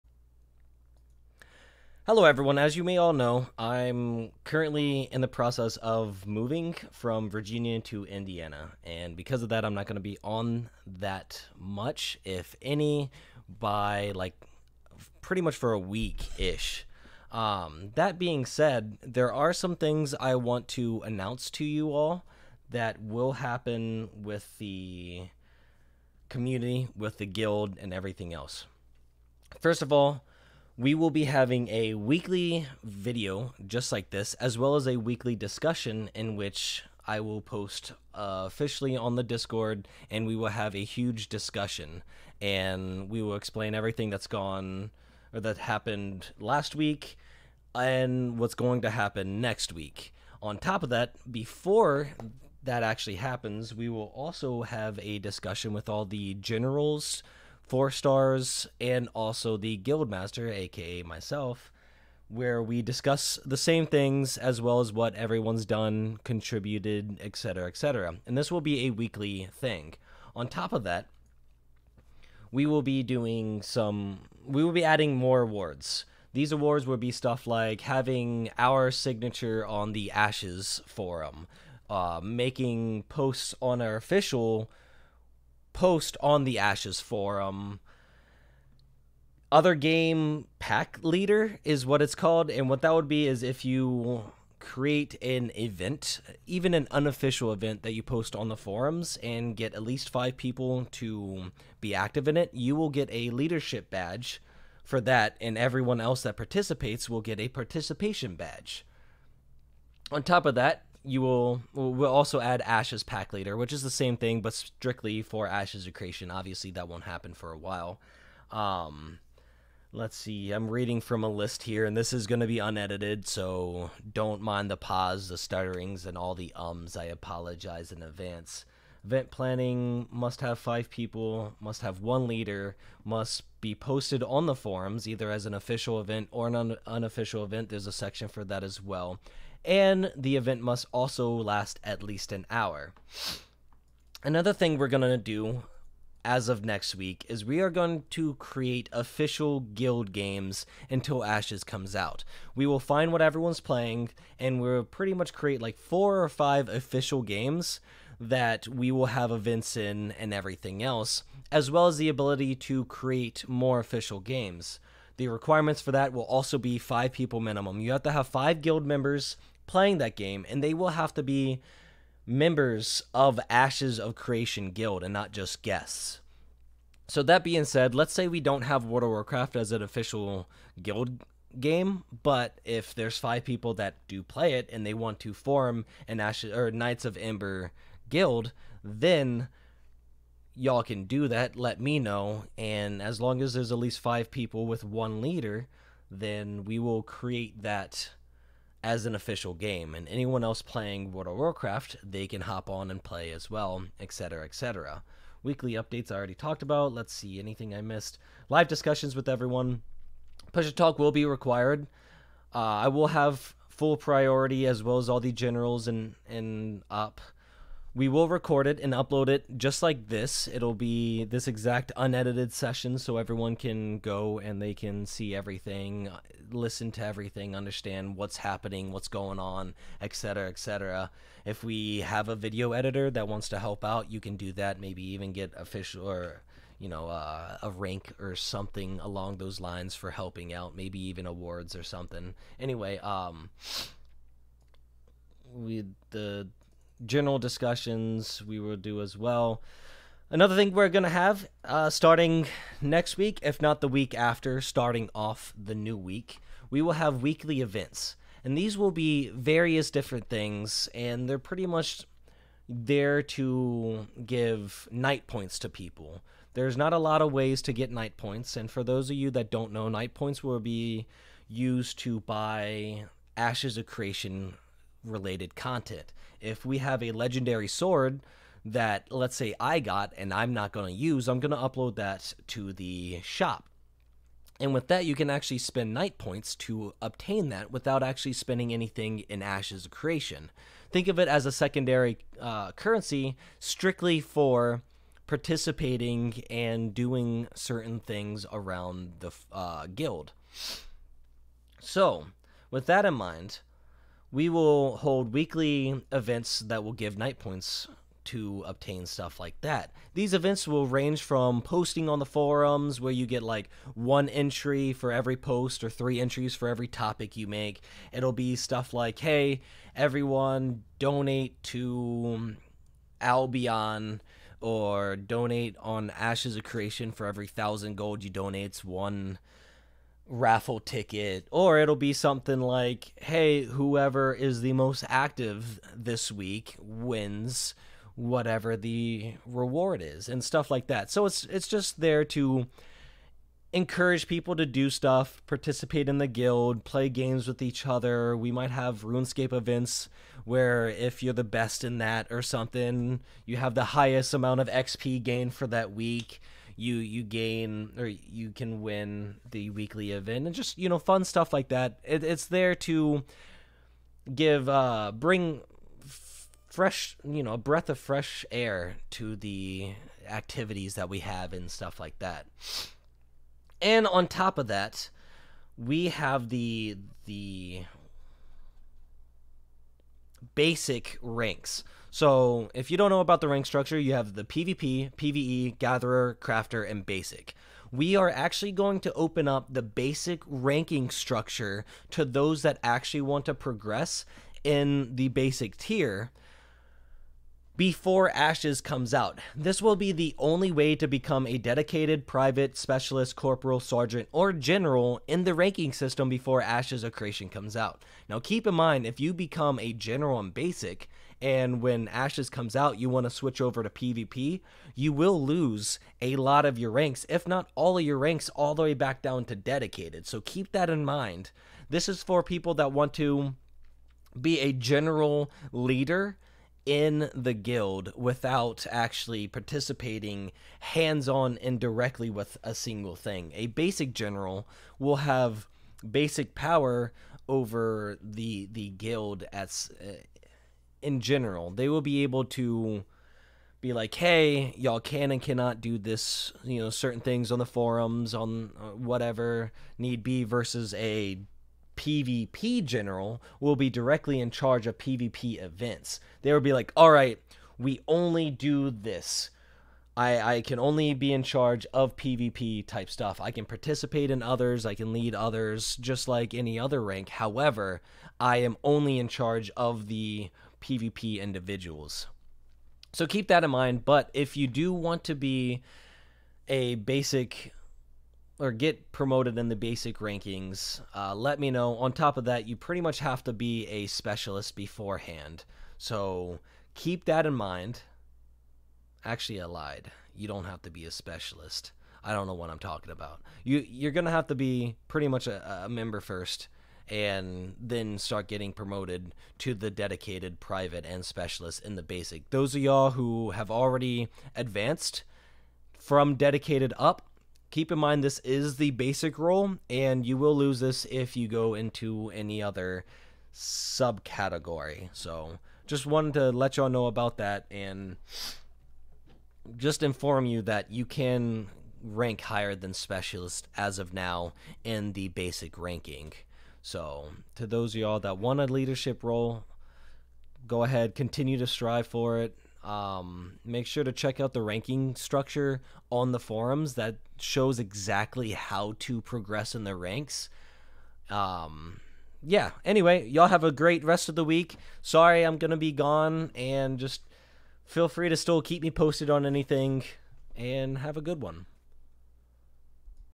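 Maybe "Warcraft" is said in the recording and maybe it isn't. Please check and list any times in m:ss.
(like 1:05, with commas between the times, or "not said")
2:59, 3:21.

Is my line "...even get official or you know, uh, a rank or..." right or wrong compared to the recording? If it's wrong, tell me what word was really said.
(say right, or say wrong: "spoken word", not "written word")
right.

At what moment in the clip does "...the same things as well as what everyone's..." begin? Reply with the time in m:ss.
1:03.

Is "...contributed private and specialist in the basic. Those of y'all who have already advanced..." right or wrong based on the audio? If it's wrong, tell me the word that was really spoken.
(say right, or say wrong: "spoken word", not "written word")
wrong: "dedicated", not "contributed".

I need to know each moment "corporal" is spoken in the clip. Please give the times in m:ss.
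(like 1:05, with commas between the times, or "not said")
6:43.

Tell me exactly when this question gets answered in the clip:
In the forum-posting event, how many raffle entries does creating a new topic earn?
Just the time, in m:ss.
5:15.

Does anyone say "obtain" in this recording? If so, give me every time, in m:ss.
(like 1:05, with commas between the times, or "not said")
4:47, 5:08.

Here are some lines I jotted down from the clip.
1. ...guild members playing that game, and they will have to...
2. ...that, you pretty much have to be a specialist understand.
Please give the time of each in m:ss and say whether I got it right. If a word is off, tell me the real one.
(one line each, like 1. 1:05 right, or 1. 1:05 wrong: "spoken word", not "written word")
1. 2:48 right
2. 8:02 wrong: "beforehand", not "understand".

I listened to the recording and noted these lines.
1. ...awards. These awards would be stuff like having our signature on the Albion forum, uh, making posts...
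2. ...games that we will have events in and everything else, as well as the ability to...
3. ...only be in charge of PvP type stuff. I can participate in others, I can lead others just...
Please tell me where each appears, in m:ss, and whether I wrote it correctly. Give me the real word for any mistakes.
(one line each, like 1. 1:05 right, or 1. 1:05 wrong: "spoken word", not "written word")
1. 1:15 wrong: "Ashes", not "Albion"
2. 2:37 right
3. 7:40 right.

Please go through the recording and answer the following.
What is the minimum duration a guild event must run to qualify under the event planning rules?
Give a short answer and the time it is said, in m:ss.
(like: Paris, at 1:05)
an hour, at 2:21.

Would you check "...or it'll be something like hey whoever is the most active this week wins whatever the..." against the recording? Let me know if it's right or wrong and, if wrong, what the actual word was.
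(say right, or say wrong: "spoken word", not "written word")
right.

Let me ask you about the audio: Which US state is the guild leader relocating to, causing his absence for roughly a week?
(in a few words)
Indiana.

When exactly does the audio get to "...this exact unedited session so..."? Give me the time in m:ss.
3:41.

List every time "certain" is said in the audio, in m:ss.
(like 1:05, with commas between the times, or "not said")
4:57, 7:26.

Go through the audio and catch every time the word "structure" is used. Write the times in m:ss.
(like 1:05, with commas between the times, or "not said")
6:23, 6:31, 8:55.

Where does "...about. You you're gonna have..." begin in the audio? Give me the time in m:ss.
8:13.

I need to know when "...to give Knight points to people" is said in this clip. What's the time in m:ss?
4:23.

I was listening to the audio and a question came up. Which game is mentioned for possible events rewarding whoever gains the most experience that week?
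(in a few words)
RuneScape.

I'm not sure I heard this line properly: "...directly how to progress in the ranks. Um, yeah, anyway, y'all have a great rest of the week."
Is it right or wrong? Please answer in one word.
wrong.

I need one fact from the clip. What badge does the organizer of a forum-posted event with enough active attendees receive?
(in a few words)
leadership badge.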